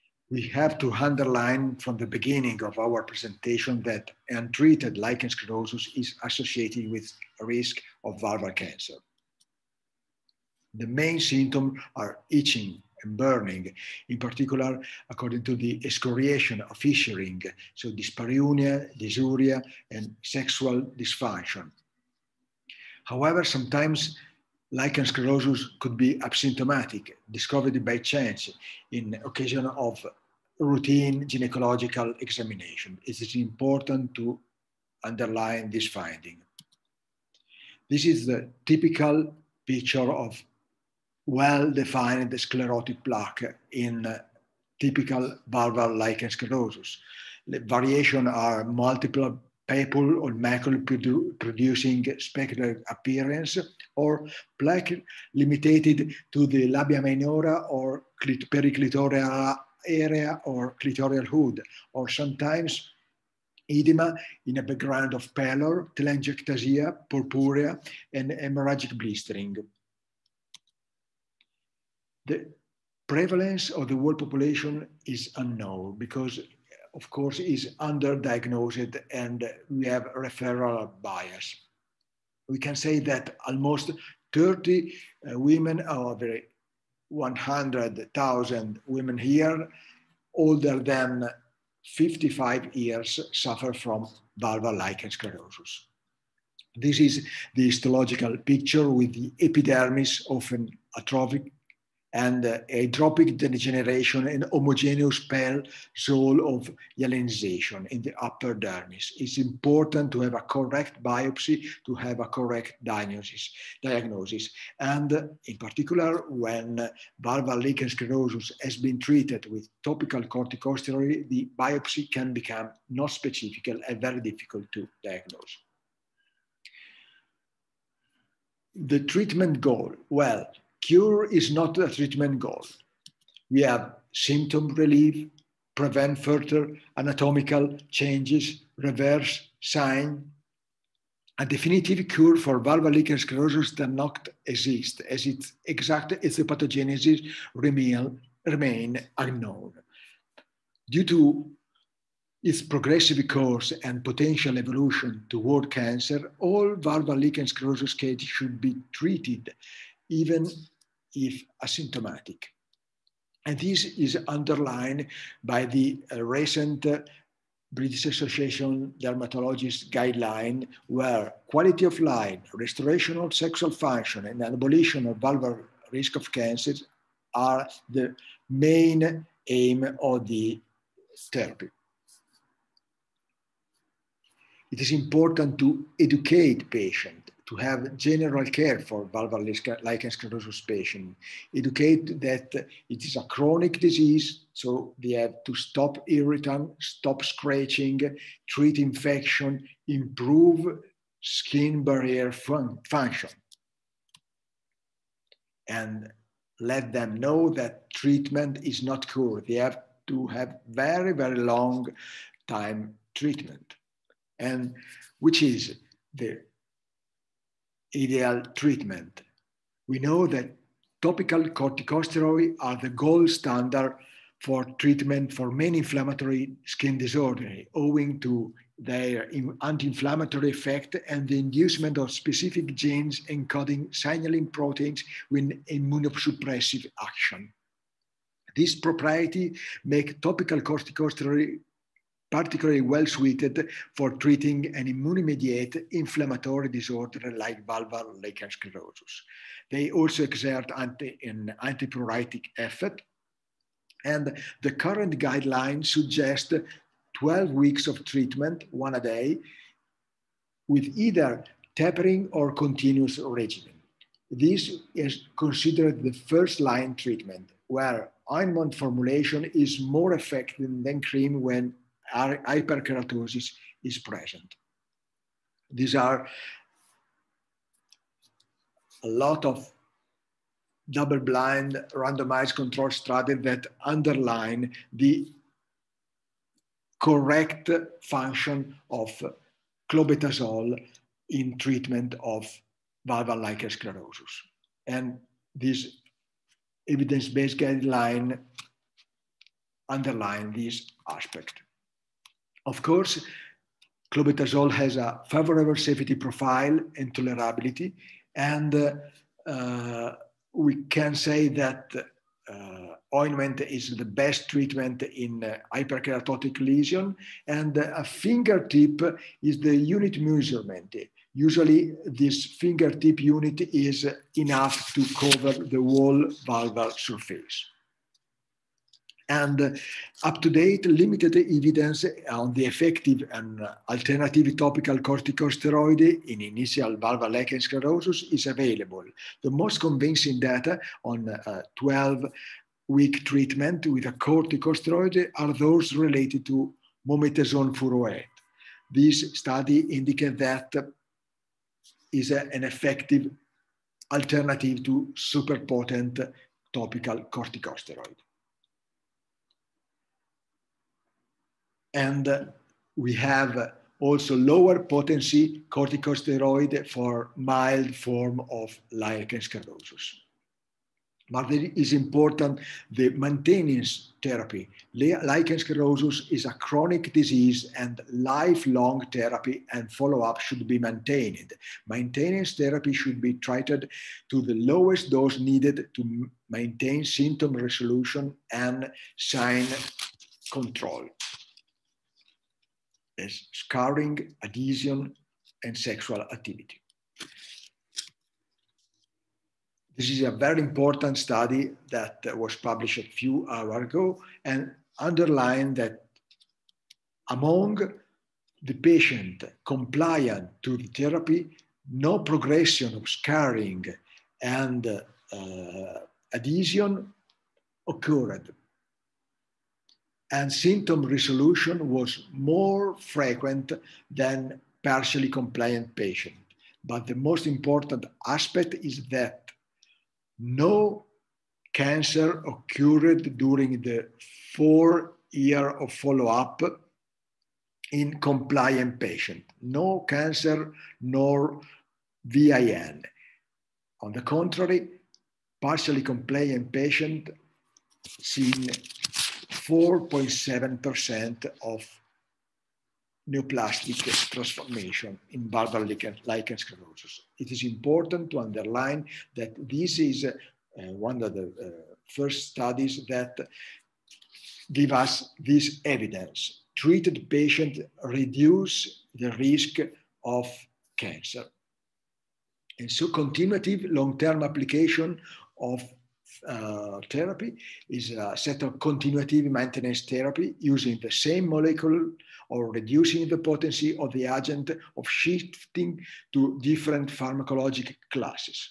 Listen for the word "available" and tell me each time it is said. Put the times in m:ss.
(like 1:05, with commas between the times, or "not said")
5:38.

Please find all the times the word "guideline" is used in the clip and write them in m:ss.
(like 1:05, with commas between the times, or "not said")
2:49, 4:15, 4:57.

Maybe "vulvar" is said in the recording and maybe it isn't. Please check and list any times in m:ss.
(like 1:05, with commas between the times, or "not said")
0:08, 1:34, 1:57, 2:55, 3:09.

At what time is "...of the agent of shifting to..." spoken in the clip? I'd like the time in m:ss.
8:03.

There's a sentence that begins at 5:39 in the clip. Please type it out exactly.
The most convincing data on uh, 12 week treatment with a corticosteroid are those related to mometasone furoate.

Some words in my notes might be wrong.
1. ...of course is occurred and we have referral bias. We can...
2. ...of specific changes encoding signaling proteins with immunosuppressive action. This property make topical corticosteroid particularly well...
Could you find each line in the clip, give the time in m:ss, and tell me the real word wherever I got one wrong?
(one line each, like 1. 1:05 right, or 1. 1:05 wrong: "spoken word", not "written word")
1. 1:16 wrong: "underdiagnosed", not "occurred"
2. 3:51 wrong: "genes", not "changes".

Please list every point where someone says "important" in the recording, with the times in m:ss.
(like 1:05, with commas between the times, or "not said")
0:33, 1:49, 3:04, 6:11, 6:40, 7:07, 7:37.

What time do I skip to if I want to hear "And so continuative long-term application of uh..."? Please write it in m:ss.
7:52.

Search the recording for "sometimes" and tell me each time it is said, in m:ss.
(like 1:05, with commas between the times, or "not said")
0:23, 1:02.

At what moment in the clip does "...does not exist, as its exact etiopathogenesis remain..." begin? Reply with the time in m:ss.
2:23.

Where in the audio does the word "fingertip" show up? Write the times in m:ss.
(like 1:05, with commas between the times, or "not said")
5:18, 5:22.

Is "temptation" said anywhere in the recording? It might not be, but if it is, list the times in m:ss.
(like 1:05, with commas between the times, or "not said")
not said.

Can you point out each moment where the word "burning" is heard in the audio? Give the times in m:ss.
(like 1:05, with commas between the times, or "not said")
0:13.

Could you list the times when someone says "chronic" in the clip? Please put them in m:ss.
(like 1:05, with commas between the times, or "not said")
3:13, 6:16.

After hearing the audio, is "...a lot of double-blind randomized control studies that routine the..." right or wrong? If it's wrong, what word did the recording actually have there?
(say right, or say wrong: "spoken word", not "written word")
wrong: "underline", not "routine".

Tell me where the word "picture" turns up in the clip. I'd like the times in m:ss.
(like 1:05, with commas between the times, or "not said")
0:39, 1:38.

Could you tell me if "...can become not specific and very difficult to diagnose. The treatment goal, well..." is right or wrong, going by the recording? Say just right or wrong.
right.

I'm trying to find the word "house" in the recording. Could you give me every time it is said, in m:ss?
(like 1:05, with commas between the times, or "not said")
not said.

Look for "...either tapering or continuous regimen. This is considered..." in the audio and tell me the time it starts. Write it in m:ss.
4:20.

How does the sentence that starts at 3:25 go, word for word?
And let them know that treatment is not cure.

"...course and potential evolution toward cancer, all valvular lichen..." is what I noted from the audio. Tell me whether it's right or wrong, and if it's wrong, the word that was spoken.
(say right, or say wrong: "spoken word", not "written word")
right.